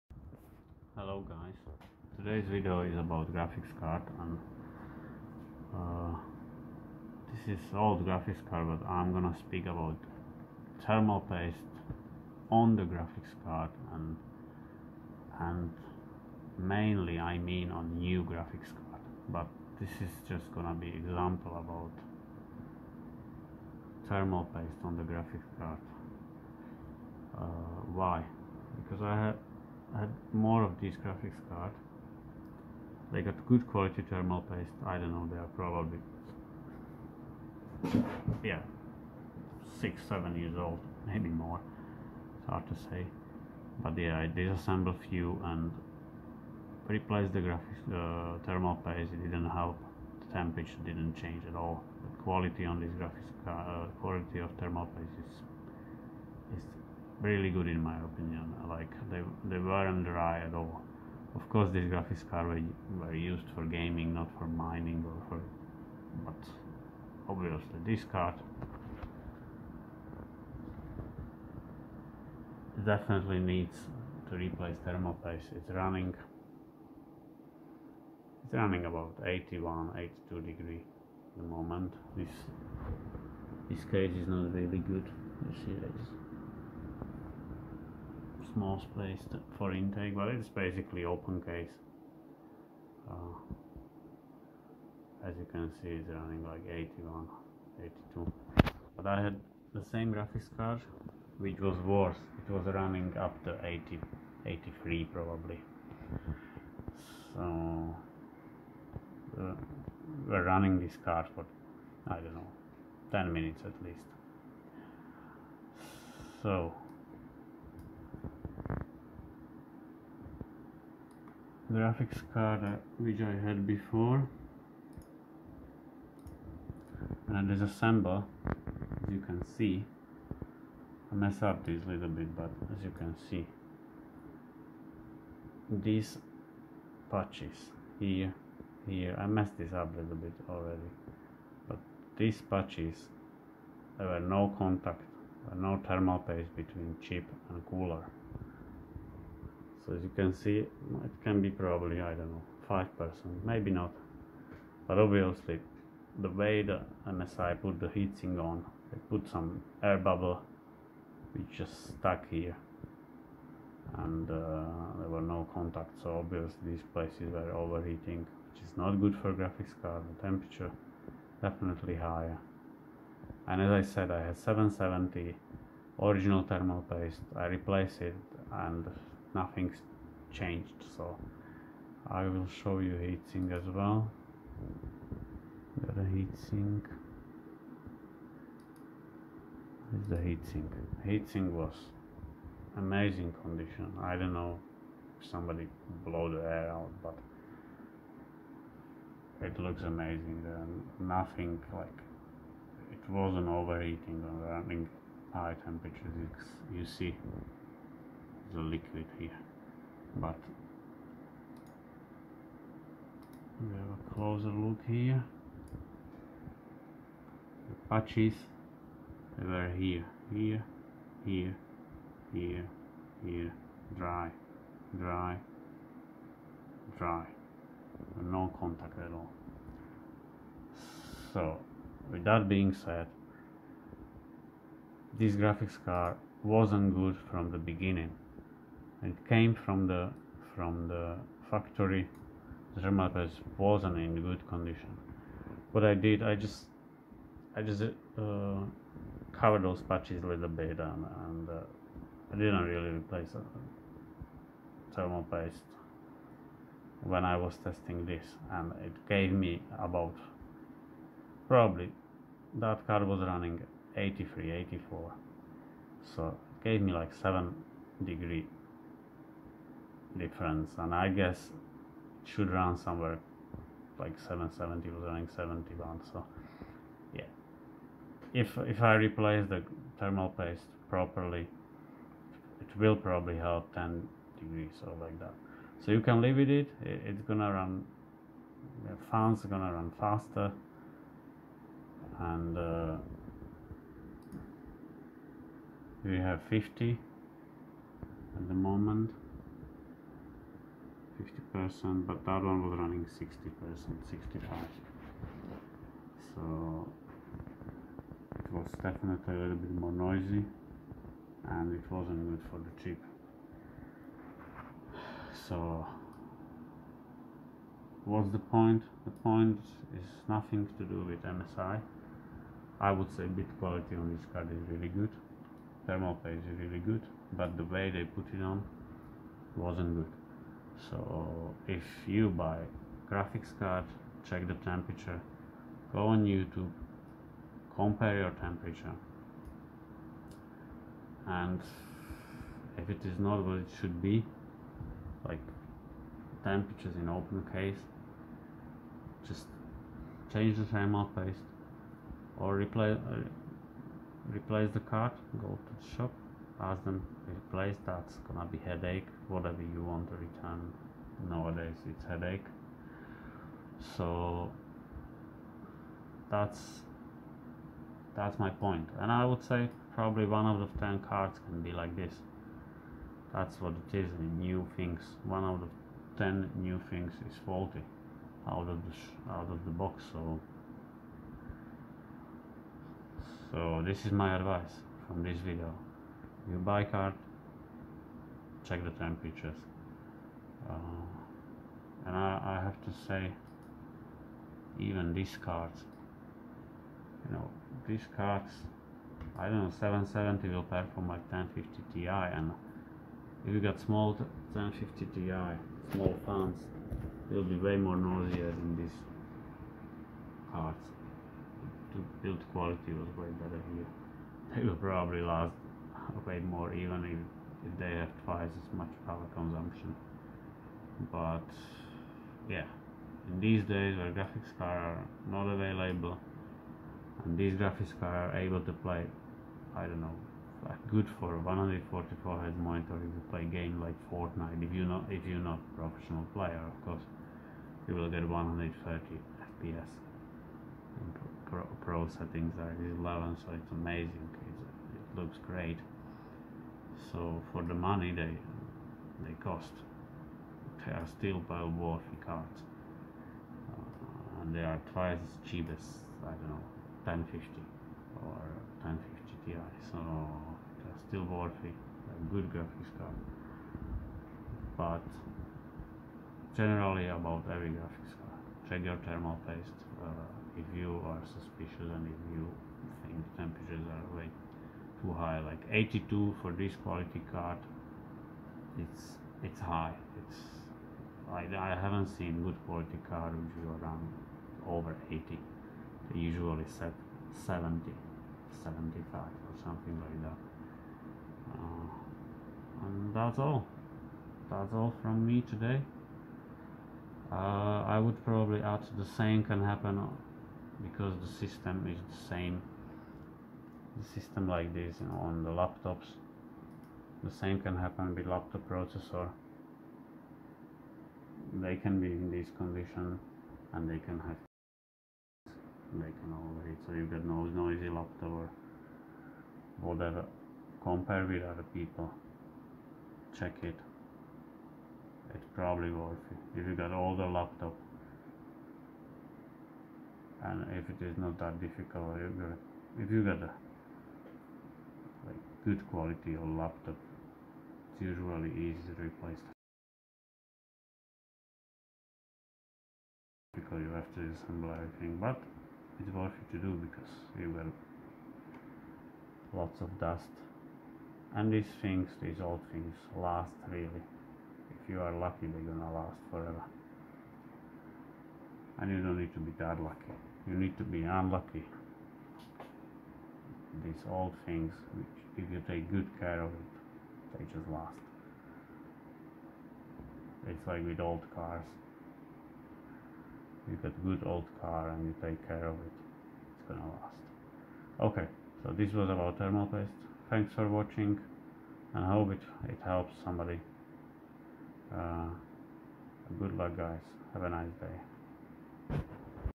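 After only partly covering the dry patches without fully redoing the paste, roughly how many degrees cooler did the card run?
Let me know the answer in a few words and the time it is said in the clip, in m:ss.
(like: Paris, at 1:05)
7 degrees, at 4:27.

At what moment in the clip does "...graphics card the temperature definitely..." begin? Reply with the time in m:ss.
2:49.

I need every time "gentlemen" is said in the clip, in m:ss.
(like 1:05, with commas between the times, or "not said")
not said.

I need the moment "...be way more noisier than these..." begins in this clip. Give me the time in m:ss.
6:47.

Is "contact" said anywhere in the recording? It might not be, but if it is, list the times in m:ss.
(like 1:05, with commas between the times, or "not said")
2:24, 2:45, 3:48.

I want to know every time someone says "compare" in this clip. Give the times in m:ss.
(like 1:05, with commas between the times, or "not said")
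5:37, 8:40.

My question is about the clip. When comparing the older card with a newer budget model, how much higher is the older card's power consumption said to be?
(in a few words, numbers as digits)
twice as much.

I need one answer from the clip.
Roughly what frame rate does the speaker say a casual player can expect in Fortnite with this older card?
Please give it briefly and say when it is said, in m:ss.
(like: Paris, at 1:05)
130 FPS, at 7:18.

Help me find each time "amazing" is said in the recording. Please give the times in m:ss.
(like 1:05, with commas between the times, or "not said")
3:12, 3:19, 7:23.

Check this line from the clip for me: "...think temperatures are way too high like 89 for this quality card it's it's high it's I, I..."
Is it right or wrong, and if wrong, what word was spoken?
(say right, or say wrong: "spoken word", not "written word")
wrong: "82", not "89".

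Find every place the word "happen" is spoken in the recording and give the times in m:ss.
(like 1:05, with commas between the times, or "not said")
8:19, 8:27.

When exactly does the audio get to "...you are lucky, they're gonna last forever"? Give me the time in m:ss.
9:14.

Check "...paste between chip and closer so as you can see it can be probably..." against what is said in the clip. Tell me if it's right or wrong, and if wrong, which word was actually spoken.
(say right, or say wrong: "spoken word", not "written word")
wrong: "cooler", not "closer".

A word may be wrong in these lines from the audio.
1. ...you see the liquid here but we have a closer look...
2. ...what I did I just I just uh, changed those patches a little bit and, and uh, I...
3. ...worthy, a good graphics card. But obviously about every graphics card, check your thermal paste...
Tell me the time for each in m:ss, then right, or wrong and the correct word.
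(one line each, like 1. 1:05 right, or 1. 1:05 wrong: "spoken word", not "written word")
1. 3:26 right
2. 4:05 wrong: "covered", not "changed"
3. 7:41 wrong: "generally", not "obviously".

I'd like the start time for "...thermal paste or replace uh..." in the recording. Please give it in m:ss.
5:50.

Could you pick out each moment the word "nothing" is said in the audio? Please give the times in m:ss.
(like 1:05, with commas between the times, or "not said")
2:59, 3:20, 5:20.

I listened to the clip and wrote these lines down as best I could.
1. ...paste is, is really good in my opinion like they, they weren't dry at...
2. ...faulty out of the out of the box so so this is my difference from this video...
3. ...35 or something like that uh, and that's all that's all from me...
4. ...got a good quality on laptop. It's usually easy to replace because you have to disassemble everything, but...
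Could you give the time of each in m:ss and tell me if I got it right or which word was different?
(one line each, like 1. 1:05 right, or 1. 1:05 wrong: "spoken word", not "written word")
1. 0:54 right
2. 6:17 wrong: "advice", not "difference"
3. 8:08 wrong: "75", not "35"
4. 8:53 right.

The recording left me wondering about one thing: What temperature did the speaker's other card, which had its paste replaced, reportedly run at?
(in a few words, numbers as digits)
71.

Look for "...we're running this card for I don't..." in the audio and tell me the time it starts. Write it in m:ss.
1:50.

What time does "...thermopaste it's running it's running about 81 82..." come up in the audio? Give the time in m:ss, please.
1:14.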